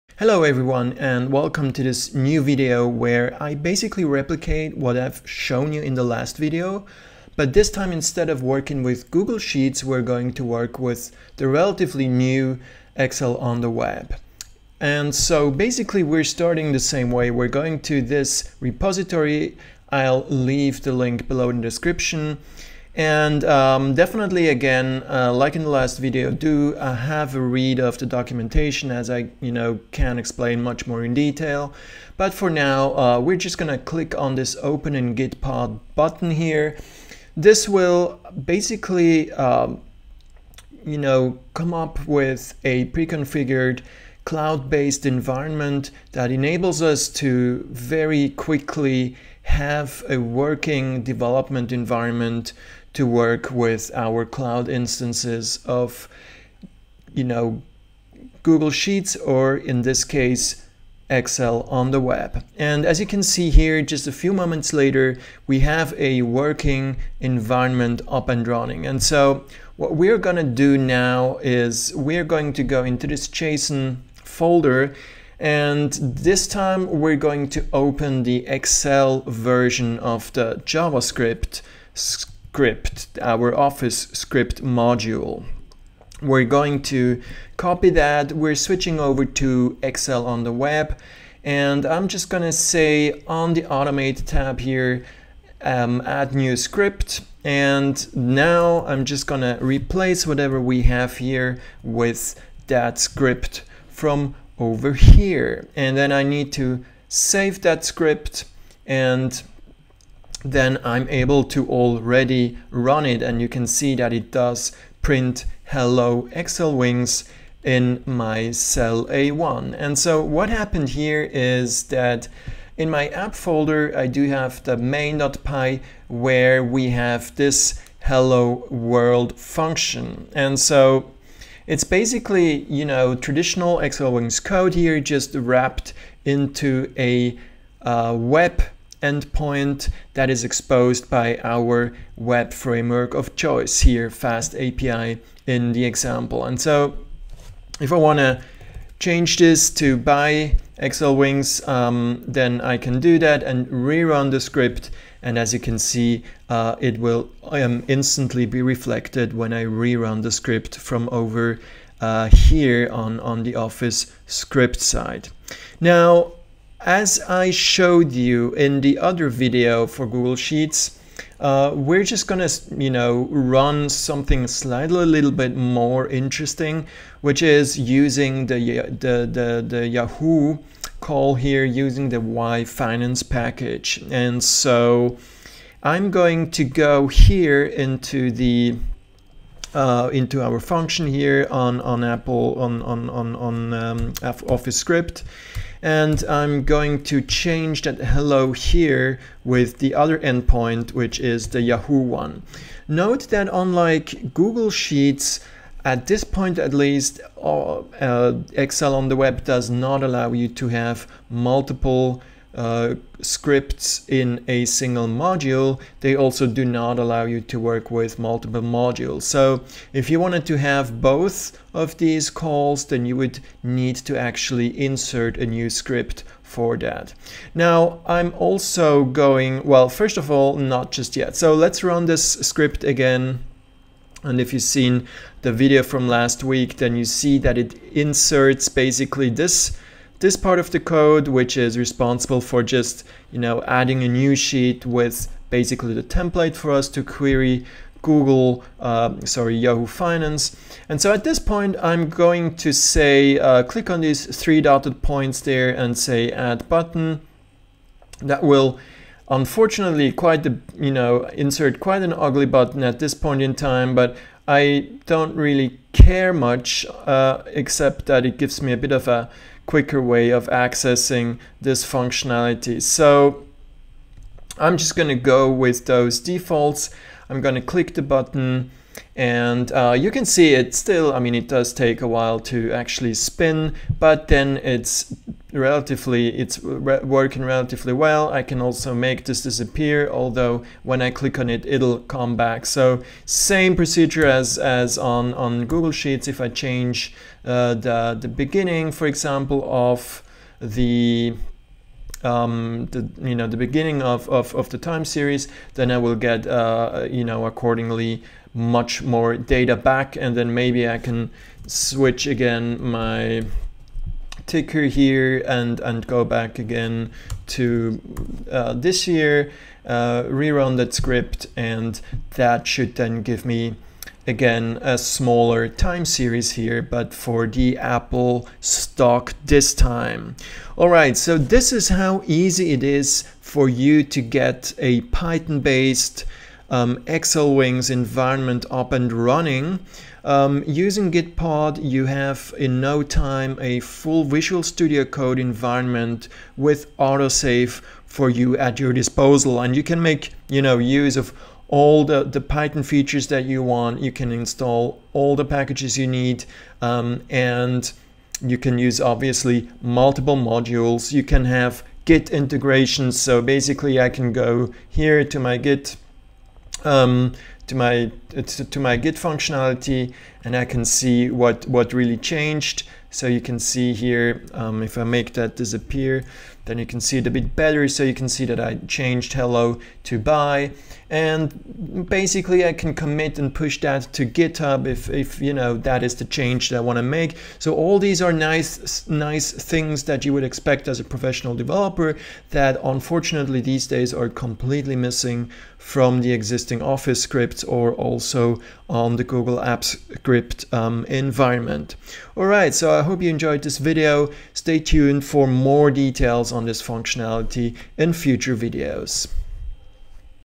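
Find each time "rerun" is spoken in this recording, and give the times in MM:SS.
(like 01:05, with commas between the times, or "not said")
02:33, 02:39, 05:20.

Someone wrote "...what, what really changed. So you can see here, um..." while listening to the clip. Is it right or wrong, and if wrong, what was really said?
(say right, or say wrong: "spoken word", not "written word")
right.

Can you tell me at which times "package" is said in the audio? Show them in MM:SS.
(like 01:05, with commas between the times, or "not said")
03:03, 05:55.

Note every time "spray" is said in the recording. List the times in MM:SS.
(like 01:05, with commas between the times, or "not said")
not said.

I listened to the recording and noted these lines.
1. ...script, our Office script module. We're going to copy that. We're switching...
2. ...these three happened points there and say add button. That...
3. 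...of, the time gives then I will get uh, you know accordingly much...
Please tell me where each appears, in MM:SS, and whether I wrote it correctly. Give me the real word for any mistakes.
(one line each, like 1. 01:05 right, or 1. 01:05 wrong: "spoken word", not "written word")
1. 01:21 right
2. 04:14 wrong: "dotted", not "happened"
3. 05:04 wrong: "series", not "gives".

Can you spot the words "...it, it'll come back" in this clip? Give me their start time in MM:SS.
04:51.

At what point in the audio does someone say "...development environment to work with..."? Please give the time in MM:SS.
00:51.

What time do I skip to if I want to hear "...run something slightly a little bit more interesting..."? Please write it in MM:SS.
02:53.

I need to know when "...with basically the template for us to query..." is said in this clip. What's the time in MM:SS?
04:04.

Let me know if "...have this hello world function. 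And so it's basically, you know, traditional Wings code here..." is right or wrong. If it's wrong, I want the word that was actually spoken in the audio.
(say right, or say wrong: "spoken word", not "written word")
right.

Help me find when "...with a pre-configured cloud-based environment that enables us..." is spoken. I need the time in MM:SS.
00:42.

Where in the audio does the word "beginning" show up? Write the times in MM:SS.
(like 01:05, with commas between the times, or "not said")
04:58, 05:03.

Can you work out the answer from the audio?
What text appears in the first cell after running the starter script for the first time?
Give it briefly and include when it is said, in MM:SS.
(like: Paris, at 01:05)
hello xlwings, at 01:55.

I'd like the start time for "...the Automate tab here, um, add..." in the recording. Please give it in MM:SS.
01:33.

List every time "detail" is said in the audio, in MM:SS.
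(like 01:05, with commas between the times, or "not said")
00:31, 06:45.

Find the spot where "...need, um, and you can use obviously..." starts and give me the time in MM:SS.
05:56.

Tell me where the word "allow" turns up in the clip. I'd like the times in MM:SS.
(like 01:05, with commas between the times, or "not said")
03:30, 03:36.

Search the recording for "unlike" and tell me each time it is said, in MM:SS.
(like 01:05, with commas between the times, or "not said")
03:23.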